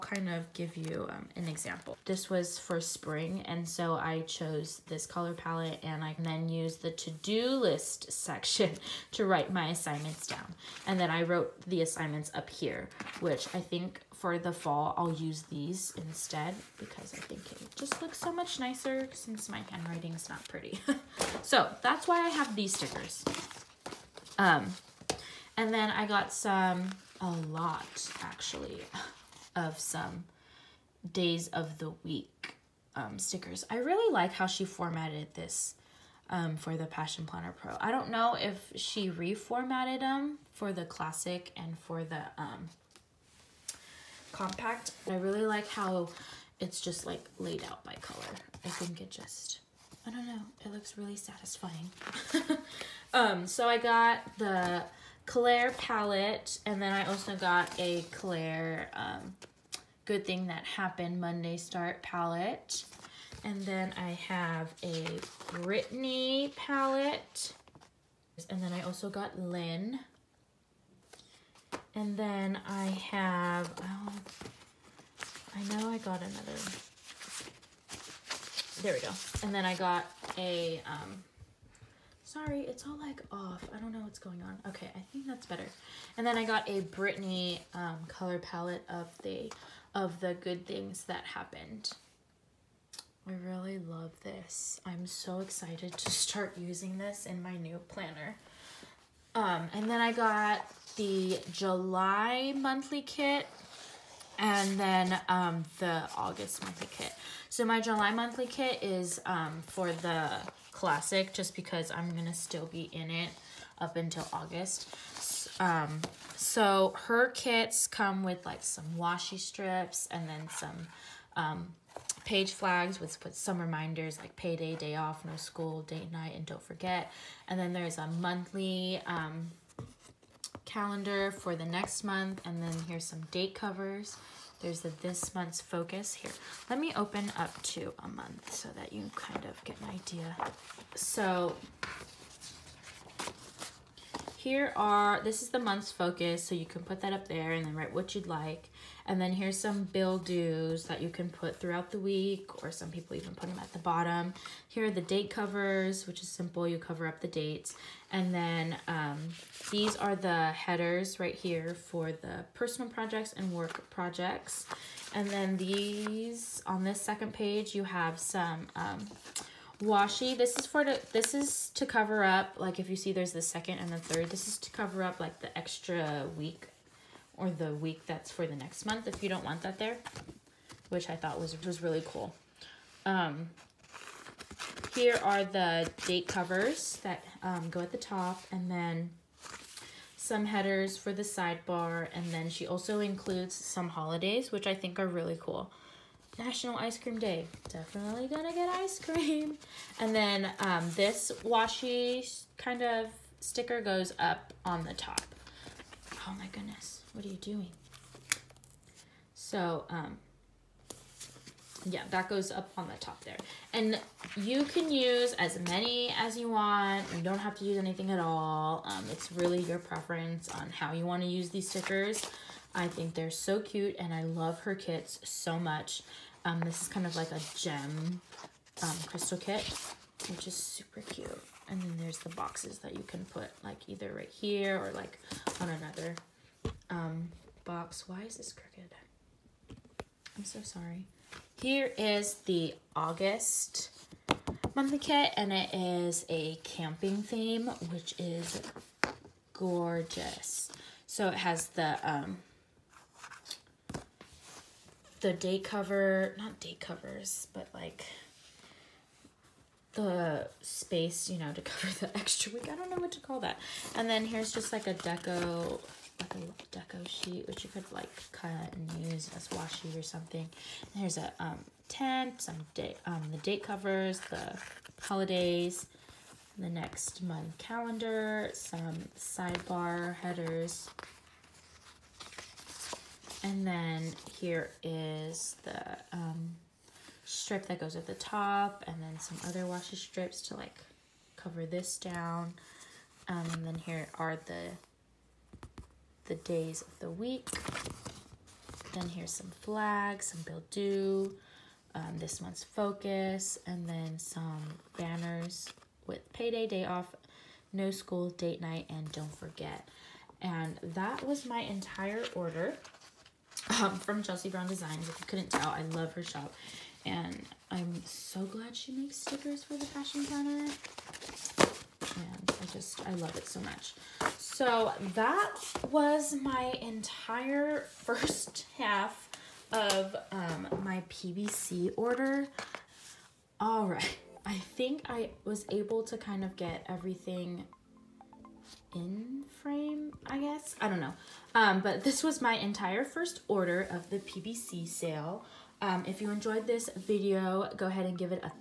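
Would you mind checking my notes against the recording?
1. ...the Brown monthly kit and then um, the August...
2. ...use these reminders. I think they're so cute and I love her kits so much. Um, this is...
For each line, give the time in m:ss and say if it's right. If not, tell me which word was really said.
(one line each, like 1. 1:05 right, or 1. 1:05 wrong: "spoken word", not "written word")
1. 1:40 wrong: "July", not "Brown"
2. 3:41 wrong: "stickers", not "reminders".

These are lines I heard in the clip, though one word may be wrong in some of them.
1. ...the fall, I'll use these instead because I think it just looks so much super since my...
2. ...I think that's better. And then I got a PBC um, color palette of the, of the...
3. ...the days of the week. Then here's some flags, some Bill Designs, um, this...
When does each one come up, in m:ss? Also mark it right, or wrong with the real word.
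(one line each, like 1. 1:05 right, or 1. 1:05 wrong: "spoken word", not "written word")
1. 0:14 wrong: "nicer", not "super"
2. 1:24 wrong: "Brittany", not "PBC"
3. 4:56 wrong: "Due", not "Designs".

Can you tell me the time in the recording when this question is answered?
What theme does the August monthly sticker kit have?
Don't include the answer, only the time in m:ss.
4:06.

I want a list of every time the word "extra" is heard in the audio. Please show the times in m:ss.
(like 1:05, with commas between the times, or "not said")
2:55, 4:22.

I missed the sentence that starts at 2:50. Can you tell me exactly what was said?
This is for to, this is to cover up like if you see there's the second and the third.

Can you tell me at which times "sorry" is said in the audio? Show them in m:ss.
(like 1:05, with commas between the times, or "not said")
1:22, 4:00.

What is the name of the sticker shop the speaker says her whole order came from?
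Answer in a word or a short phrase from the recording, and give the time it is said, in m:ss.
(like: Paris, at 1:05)
Chelsea Brown Designs, at 5:14.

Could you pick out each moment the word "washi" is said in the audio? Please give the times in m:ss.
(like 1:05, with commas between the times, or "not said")
1:58, 2:49, 3:21, 4:29, 4:49.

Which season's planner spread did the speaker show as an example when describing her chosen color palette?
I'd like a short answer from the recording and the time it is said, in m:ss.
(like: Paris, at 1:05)
Spring, at 0:02.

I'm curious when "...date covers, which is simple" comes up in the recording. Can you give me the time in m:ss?
2:35.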